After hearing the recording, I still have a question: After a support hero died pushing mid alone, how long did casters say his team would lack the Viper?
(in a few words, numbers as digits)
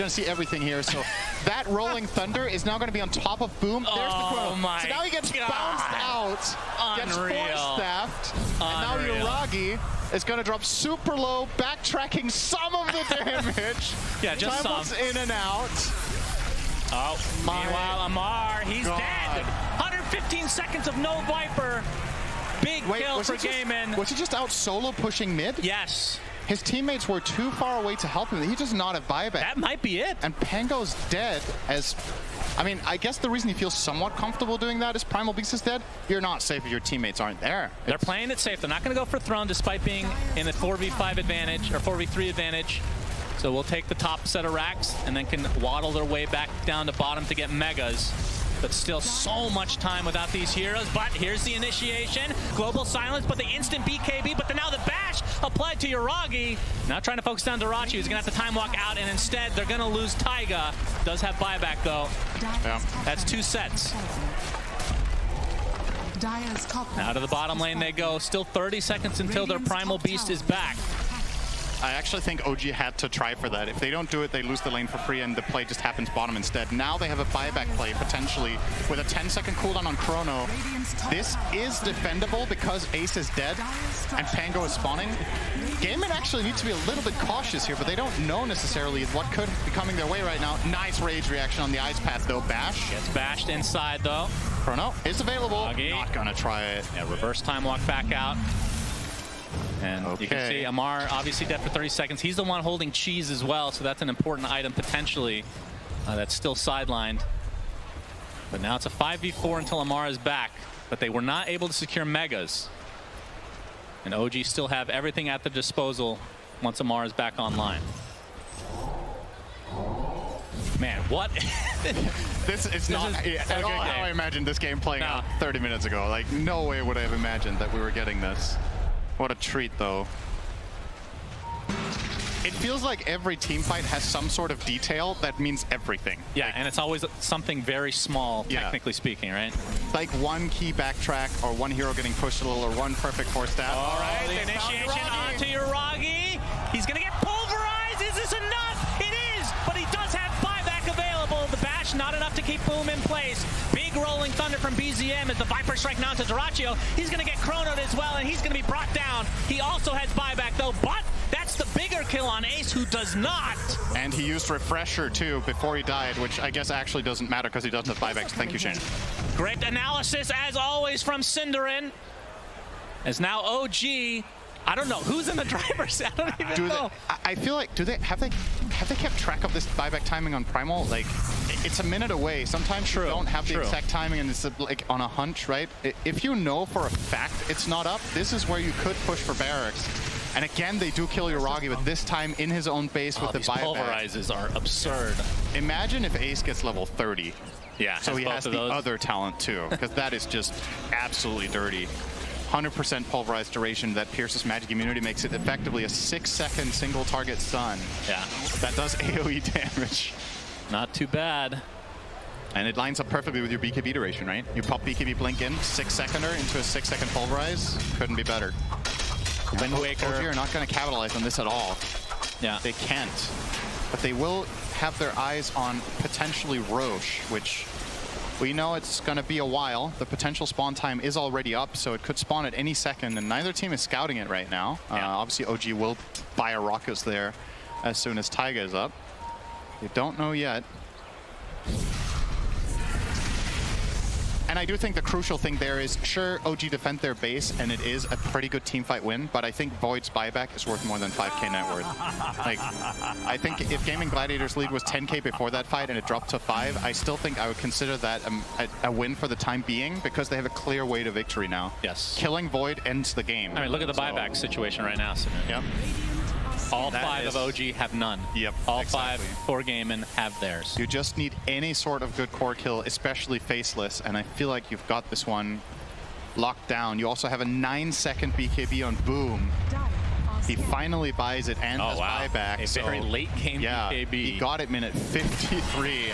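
15 seconds.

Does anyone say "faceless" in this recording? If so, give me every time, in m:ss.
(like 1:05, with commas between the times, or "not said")
4:33.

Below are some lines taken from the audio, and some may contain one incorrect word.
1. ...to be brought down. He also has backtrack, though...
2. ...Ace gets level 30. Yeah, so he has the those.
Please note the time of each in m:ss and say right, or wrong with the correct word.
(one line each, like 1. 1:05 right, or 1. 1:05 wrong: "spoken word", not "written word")
1. 2:38 wrong: "buyback", not "backtrack"
2. 3:16 right.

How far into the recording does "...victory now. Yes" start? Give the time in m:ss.
4:21.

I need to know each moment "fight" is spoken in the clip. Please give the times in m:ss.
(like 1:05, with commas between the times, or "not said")
2:13, 4:08, 4:15.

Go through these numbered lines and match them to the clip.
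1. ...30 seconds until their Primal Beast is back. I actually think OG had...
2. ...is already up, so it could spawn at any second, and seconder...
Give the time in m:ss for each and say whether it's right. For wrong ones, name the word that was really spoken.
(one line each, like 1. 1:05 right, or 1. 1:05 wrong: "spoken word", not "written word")
1. 1:08 right
2. 3:50 wrong: "neither", not "seconder".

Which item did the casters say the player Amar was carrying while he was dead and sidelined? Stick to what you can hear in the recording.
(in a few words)
Cheese.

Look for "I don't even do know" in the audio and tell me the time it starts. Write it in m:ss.
2:56.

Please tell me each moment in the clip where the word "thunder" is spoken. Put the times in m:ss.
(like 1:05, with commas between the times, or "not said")
0:02, 2:34.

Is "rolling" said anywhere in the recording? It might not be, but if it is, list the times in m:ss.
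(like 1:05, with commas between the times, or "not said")
0:01, 2:33.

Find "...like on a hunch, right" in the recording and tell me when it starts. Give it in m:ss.
3:04.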